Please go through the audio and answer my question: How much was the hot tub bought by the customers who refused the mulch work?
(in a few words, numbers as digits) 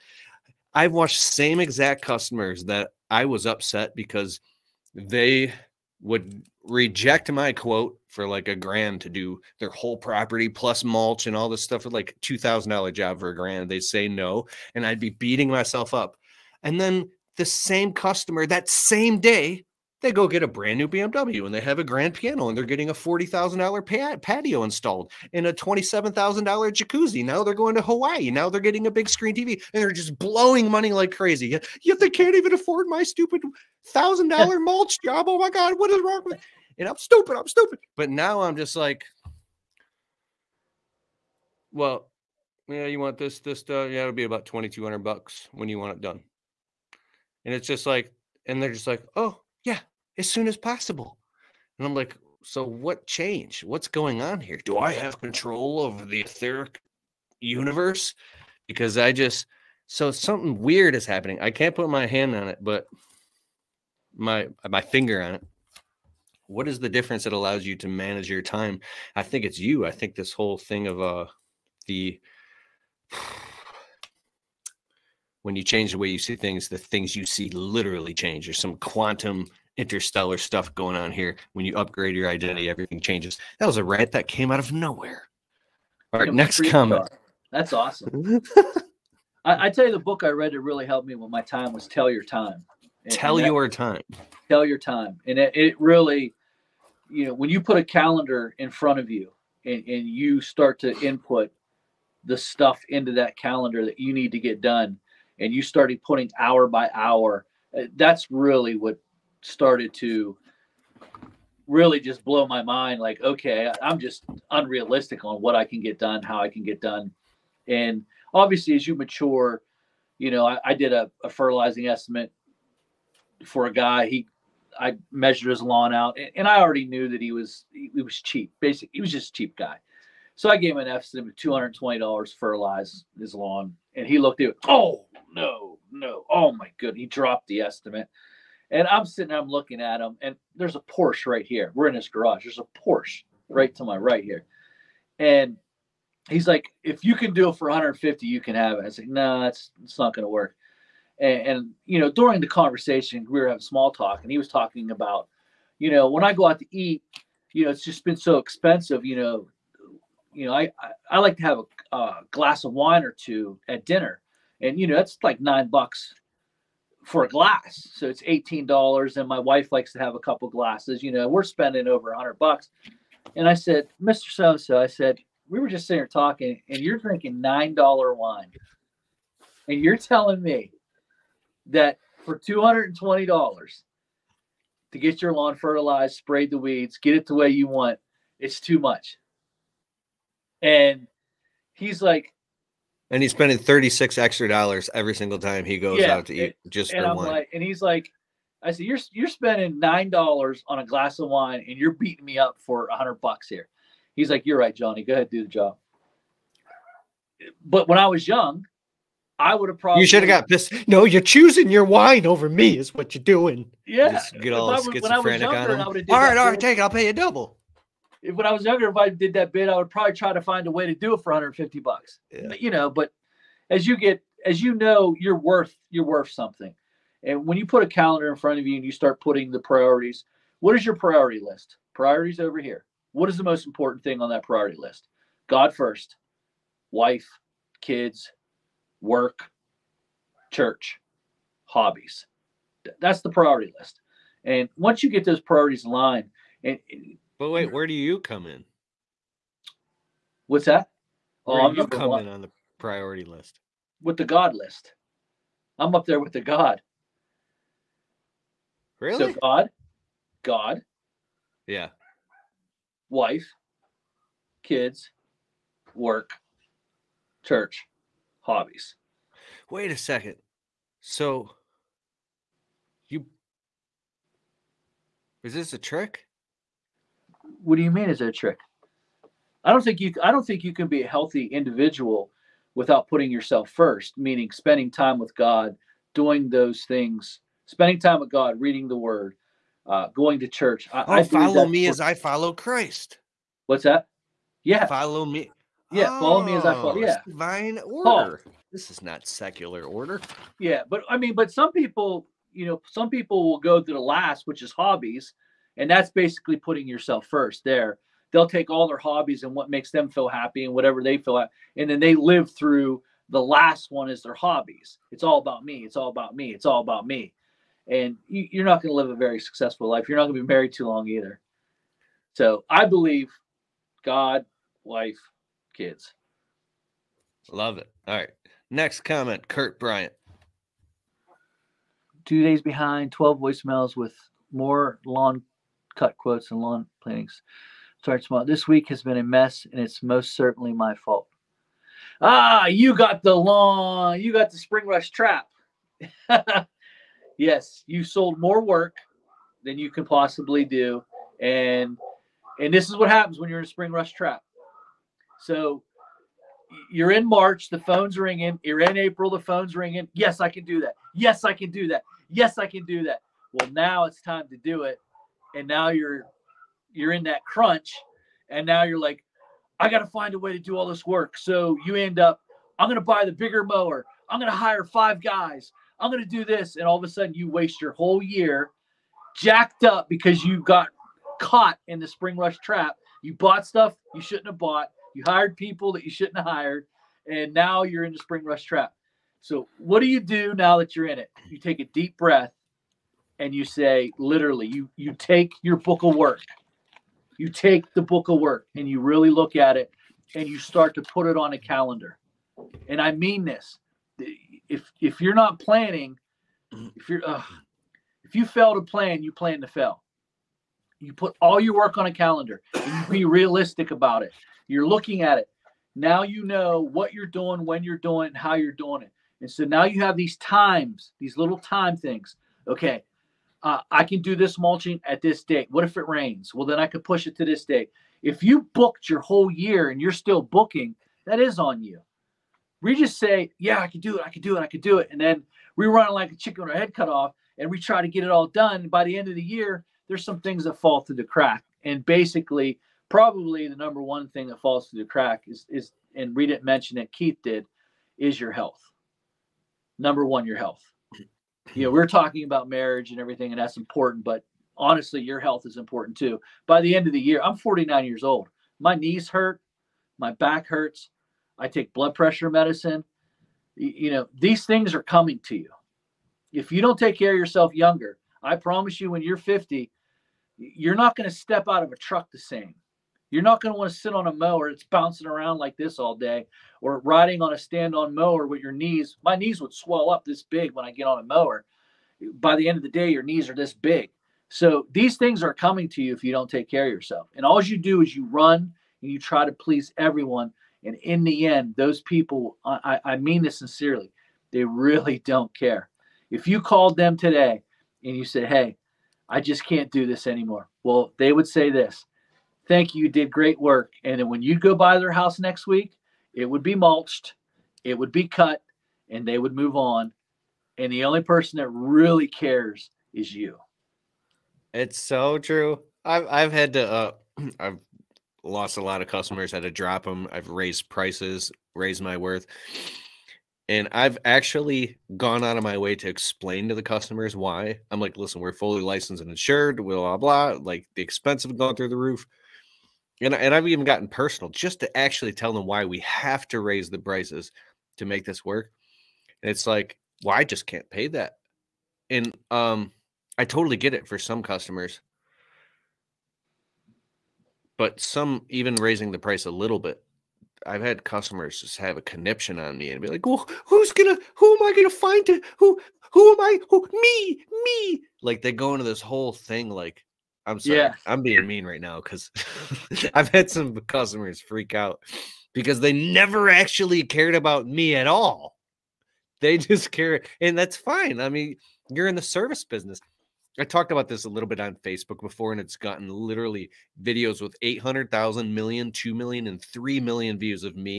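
$27,000.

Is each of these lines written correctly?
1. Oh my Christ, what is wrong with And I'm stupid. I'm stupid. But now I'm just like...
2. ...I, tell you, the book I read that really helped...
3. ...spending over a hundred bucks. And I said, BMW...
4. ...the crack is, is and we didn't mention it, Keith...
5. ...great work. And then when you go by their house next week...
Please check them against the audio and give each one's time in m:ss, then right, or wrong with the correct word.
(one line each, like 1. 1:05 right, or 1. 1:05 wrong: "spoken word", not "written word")
1. 0:35 wrong: "God", not "Christ"
2. 1:29 right
3. 2:51 wrong: "Mister", not "BMW"
4. 7:25 right
5. 8:23 right.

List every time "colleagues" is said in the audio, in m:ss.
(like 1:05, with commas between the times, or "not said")
not said.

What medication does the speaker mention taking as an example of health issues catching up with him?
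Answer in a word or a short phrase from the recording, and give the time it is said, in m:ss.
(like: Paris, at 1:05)
blood pressure medicine, at 7:41.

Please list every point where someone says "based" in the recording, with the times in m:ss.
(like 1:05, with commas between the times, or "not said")
not said.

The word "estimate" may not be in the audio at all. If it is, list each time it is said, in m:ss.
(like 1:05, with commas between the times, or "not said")
2:01, 2:10, 2:17.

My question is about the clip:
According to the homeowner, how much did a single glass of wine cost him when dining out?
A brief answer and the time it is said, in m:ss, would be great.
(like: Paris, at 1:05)
9 dollars, at 2:45.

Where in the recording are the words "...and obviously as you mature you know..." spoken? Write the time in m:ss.
1:57.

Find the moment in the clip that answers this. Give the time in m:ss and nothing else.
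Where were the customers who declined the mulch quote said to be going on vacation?
0:27.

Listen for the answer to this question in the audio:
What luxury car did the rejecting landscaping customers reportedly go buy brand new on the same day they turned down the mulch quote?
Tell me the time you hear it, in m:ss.
0:20.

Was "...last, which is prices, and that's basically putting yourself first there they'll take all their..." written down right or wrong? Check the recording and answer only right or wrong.
wrong.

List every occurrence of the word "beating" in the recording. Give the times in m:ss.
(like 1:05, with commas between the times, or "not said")
0:15, 3:21.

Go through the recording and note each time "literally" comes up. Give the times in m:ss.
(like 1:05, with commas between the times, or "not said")
1:17, 6:34, 9:36.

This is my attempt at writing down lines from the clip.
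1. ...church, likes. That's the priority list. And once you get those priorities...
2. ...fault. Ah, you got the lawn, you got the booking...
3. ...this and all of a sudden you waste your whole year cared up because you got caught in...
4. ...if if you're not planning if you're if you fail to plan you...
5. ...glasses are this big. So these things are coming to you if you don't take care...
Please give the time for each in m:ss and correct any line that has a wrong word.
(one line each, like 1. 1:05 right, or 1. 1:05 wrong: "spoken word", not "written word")
1. 4:00 wrong: "hobbies", not "likes"
2. 5:40 wrong: "spring", not "booking"
3. 6:16 wrong: "jacked", not "cared"
4. 6:44 right
5. 8:03 wrong: "knees", not "glasses".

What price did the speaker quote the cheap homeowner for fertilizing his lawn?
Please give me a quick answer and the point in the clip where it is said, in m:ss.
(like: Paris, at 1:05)
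$220, at 2:11.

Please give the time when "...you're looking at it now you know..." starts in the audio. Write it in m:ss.
6:54.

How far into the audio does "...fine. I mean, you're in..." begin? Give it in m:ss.
9:30.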